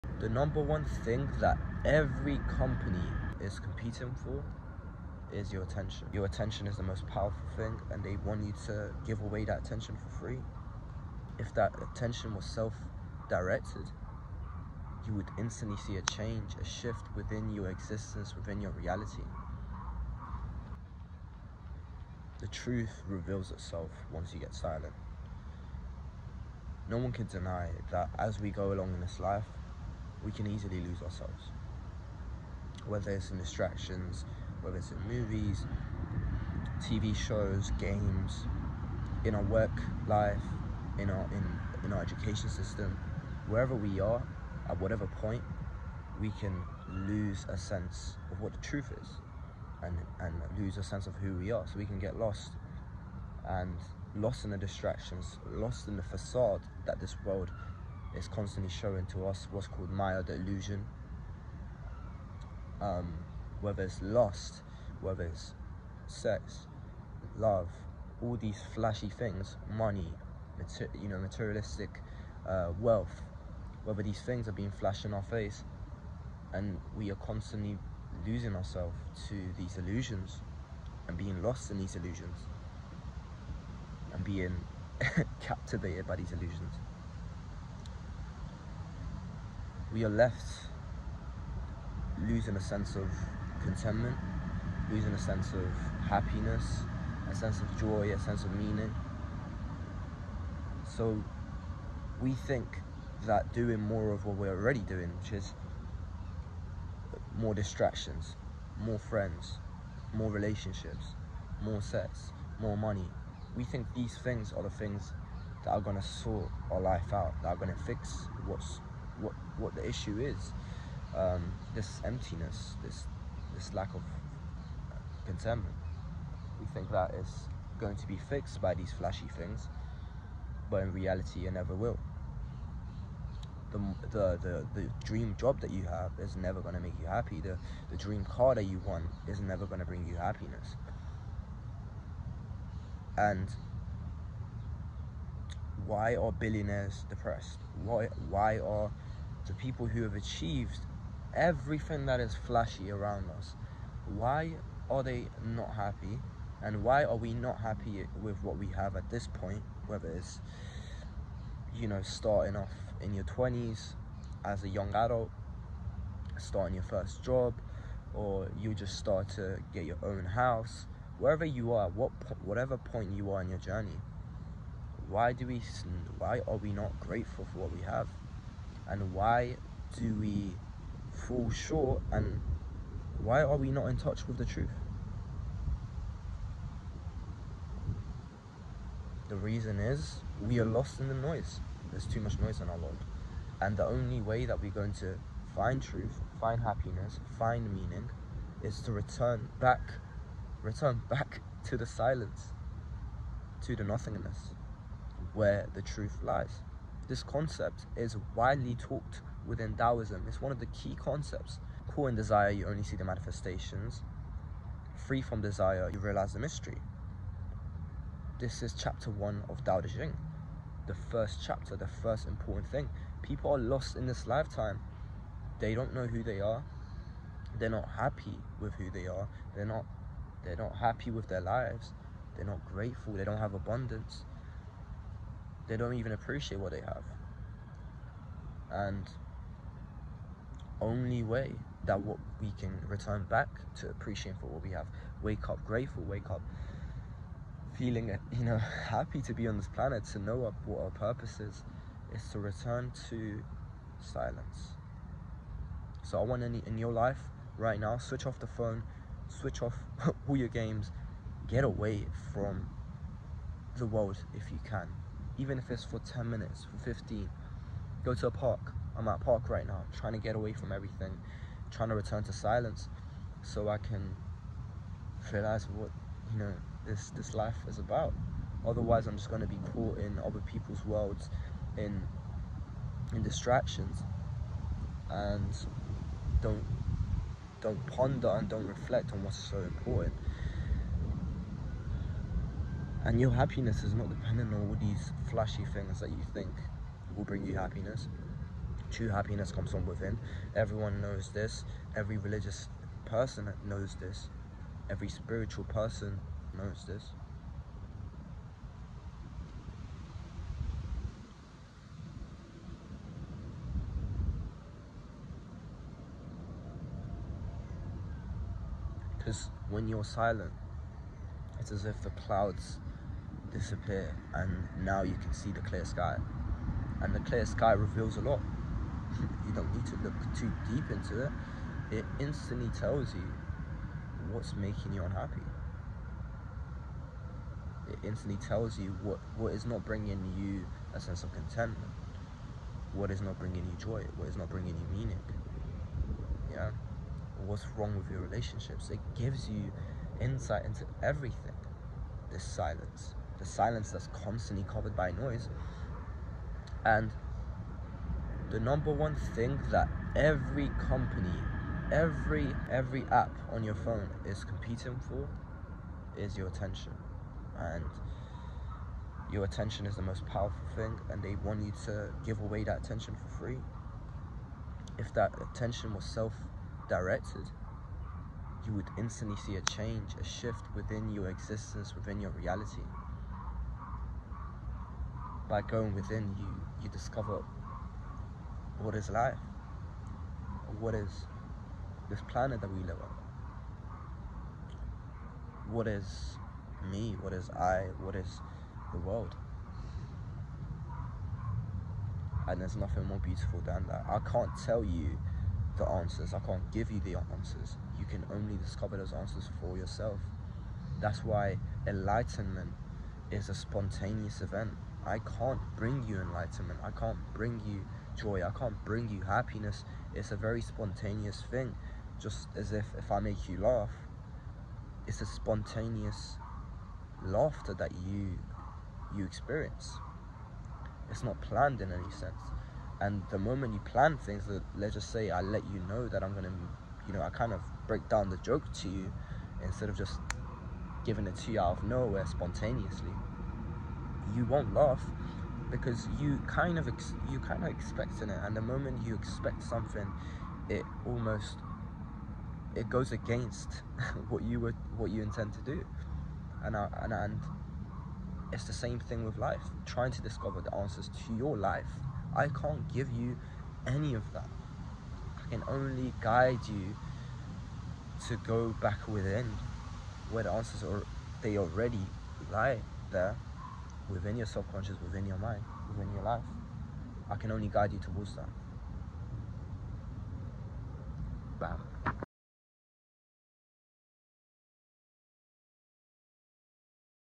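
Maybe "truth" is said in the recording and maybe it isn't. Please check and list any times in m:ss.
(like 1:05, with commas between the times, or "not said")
0:22, 0:48, 3:04, 3:15, 3:25.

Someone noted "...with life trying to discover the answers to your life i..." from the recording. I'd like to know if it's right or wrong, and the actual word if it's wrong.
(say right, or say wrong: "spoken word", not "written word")
right.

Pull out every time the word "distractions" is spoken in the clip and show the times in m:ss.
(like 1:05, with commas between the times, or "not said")
0:33, 0:54, 1:47, 4:43.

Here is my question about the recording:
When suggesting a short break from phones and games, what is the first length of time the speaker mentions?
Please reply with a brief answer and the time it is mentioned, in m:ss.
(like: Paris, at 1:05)
10 minutes, at 4:25.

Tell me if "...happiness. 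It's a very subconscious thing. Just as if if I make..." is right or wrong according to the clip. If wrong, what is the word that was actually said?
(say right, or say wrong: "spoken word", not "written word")
wrong: "spontaneous", not "subconscious".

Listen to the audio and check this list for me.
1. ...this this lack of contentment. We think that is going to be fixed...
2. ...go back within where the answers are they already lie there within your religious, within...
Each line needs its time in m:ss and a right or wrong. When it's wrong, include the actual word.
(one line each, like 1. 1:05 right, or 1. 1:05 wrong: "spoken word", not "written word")
1. 2:02 right
2. 7:48 wrong: "subconscious", not "religious".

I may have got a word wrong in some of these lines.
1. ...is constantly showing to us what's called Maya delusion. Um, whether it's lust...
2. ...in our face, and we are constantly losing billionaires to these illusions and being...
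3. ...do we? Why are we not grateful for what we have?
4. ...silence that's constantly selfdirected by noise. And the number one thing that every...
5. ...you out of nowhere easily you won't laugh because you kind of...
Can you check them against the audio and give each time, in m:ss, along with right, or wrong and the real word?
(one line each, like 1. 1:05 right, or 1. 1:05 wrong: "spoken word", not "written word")
1. 0:58 right
2. 1:15 wrong: "ourselves", not "billionaires"
3. 2:55 right
4. 5:53 wrong: "covered", not "selfdirected"
5. 7:21 wrong: "spontaneously", not "easily".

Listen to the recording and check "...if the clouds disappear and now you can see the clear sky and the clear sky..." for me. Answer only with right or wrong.
right.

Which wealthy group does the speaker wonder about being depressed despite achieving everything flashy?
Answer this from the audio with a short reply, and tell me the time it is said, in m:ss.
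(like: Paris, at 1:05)
Billionaires, at 2:26.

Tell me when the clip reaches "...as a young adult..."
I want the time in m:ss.
2:44.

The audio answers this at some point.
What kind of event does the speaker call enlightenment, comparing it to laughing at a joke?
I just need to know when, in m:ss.
6:53.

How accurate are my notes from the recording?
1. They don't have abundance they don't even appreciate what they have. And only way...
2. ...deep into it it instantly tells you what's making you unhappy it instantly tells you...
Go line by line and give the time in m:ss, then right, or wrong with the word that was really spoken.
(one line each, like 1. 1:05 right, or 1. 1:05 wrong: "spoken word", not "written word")
1. 3:53 right
2. 5:30 right.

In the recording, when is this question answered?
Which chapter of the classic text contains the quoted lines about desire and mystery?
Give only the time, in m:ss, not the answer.
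3:38.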